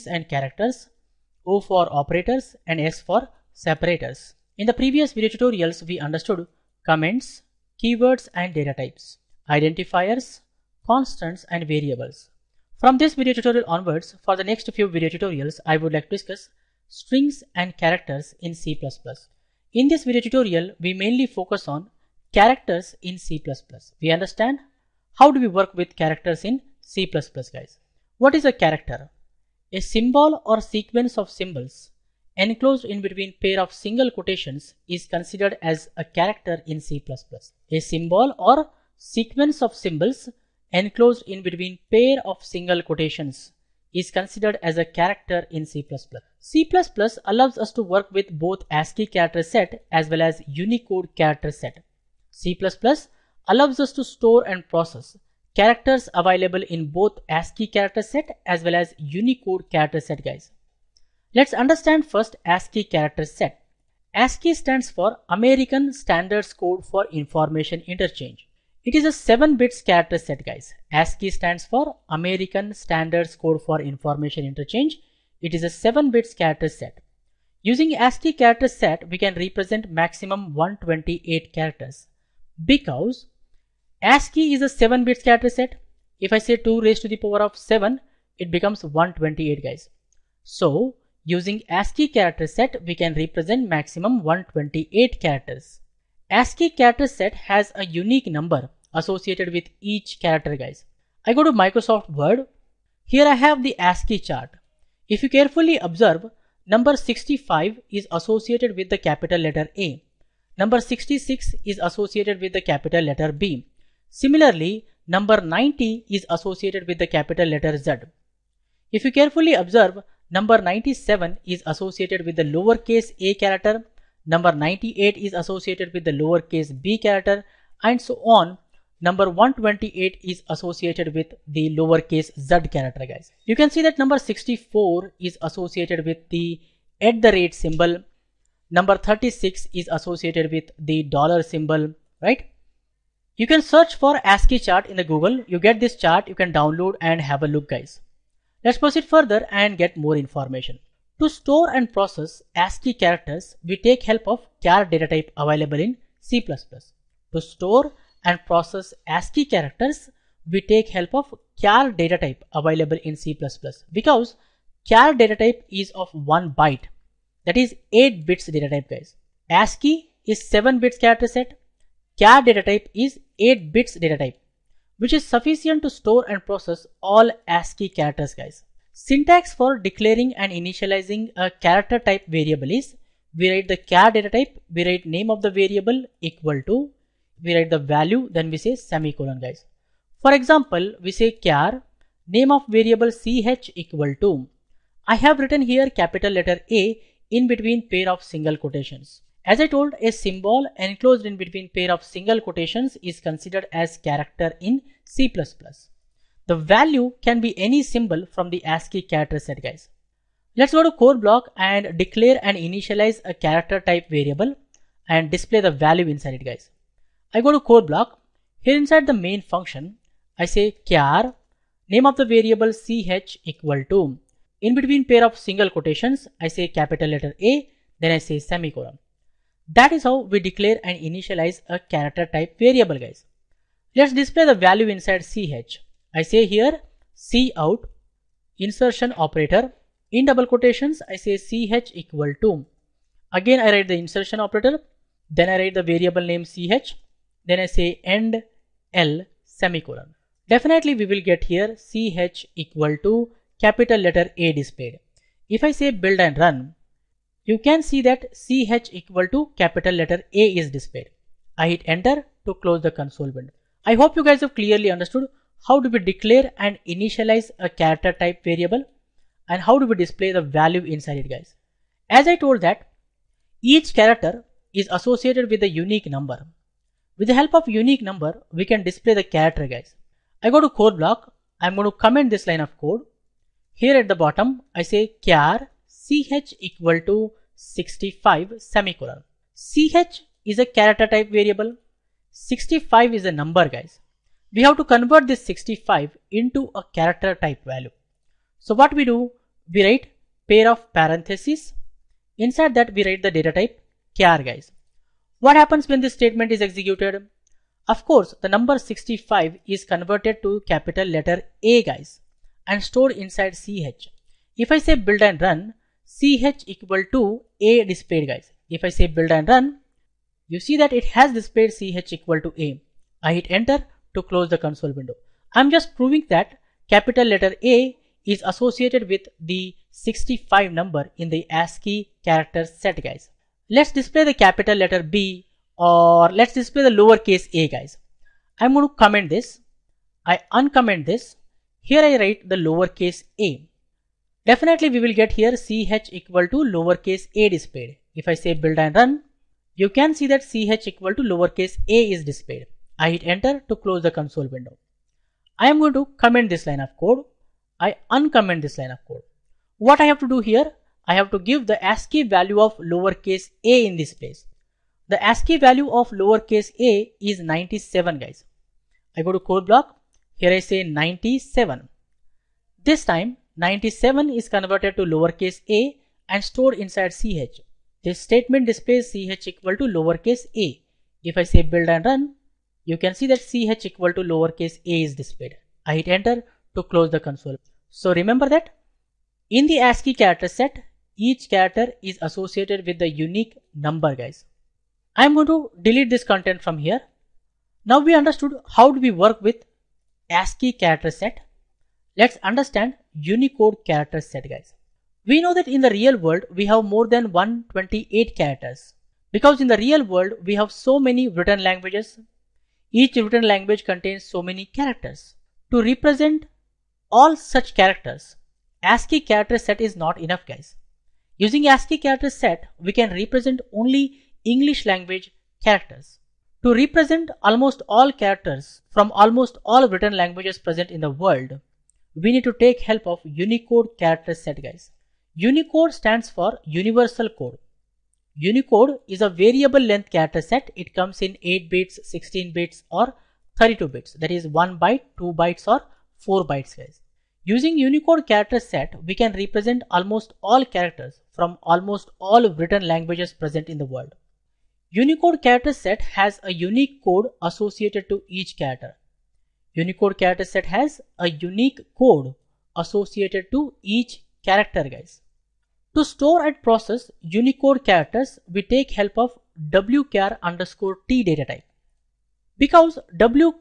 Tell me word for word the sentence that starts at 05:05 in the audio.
What happens when this statement is executed?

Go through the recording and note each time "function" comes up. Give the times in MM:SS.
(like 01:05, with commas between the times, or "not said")
03:39.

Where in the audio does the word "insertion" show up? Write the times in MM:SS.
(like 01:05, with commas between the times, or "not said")
03:58, 04:03.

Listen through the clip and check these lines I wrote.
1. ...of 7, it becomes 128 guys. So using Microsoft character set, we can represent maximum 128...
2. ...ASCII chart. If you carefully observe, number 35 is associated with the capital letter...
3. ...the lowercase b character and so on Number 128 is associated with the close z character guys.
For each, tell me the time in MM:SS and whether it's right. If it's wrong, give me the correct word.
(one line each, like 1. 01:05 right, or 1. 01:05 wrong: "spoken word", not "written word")
1. 01:27 wrong: "ASCII", not "Microsoft"
2. 01:43 wrong: "65", not "35"
3. 02:06 wrong: "lowercase", not "close".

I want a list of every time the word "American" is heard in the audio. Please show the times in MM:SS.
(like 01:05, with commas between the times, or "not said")
01:05, 01:12.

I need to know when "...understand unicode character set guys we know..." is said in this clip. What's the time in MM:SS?
06:42.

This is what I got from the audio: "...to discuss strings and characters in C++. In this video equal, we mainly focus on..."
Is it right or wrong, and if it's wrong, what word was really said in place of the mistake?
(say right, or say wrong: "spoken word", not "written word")
wrong: "tutorial", not "equal".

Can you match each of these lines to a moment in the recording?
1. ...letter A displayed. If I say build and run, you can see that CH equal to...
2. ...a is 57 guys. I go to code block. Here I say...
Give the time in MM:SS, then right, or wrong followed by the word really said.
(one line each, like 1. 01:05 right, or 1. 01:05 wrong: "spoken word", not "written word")
1. 04:13 right
2. 06:06 wrong: "97", not "57".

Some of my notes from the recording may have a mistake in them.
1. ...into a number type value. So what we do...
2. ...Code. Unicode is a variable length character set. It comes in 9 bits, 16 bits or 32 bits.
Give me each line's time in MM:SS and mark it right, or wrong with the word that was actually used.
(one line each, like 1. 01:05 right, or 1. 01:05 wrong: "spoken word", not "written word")
1. 04:56 wrong: "character", not "number"
2. 07:17 wrong: "8", not "9".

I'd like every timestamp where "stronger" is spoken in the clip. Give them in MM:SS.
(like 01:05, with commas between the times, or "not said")
not said.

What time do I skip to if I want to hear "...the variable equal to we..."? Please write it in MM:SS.
03:05.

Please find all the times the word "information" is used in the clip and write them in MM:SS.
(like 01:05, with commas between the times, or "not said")
01:07, 01:13, 02:30.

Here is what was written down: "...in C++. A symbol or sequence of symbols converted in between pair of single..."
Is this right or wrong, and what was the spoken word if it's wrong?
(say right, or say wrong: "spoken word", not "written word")
wrong: "enclosed", not "converted".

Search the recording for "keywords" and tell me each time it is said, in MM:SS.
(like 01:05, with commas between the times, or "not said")
00:07.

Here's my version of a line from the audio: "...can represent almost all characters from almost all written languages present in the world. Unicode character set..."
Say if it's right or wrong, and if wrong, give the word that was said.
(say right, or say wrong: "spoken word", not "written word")
right.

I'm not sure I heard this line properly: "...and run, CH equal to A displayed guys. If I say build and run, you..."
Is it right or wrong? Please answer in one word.
right.